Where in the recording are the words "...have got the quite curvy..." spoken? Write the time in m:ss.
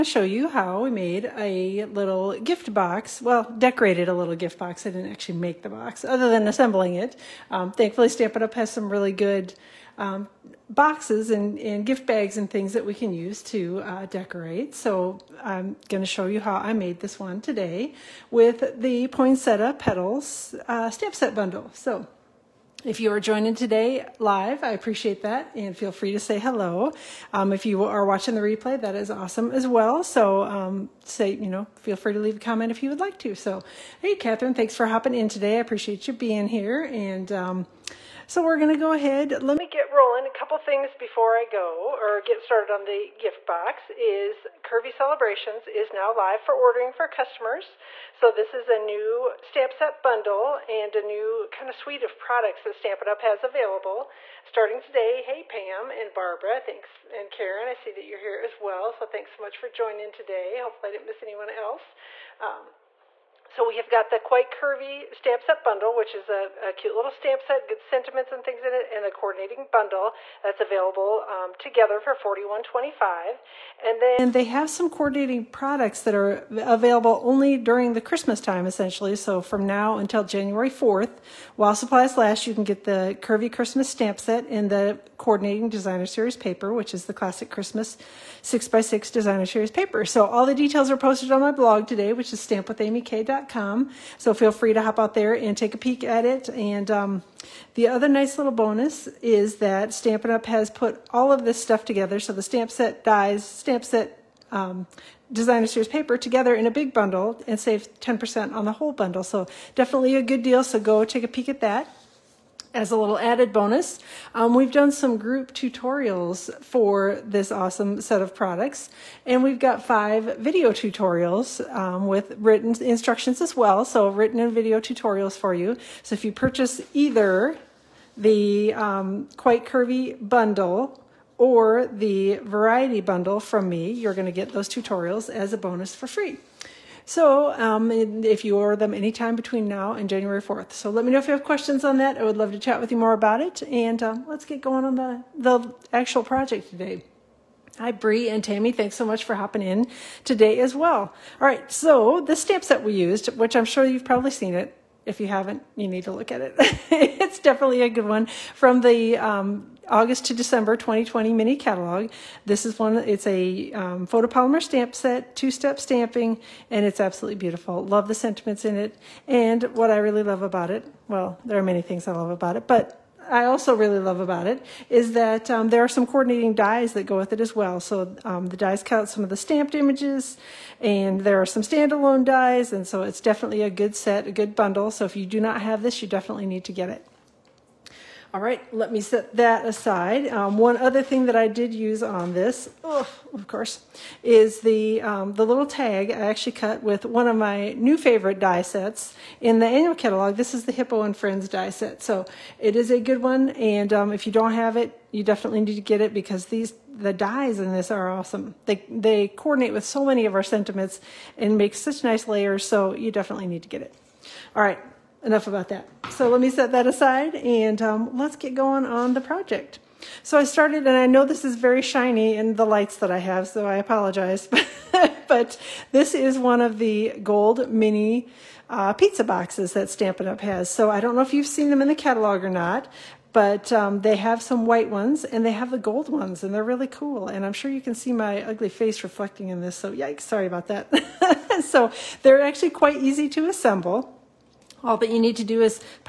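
1:03.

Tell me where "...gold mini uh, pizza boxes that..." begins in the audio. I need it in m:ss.
3:47.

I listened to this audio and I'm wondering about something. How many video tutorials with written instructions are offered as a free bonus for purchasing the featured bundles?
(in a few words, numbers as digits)
5.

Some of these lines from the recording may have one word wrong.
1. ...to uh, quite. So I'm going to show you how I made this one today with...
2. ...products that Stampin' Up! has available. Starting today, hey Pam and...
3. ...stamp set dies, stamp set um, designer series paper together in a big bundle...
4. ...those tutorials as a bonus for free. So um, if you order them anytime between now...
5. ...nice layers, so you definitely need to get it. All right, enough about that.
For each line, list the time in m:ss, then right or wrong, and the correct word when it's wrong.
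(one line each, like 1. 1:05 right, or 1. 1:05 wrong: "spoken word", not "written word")
1. 0:13 wrong: "decorate", not "quite"
2. 0:52 right
3. 1:42 right
4. 2:14 right
5. 3:32 right.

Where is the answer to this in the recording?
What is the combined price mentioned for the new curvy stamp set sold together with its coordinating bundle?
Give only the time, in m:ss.
1:12.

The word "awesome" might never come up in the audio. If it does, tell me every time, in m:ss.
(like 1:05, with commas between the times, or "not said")
0:29, 1:57, 3:28.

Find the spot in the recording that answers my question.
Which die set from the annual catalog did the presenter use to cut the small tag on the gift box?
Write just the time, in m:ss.
3:20.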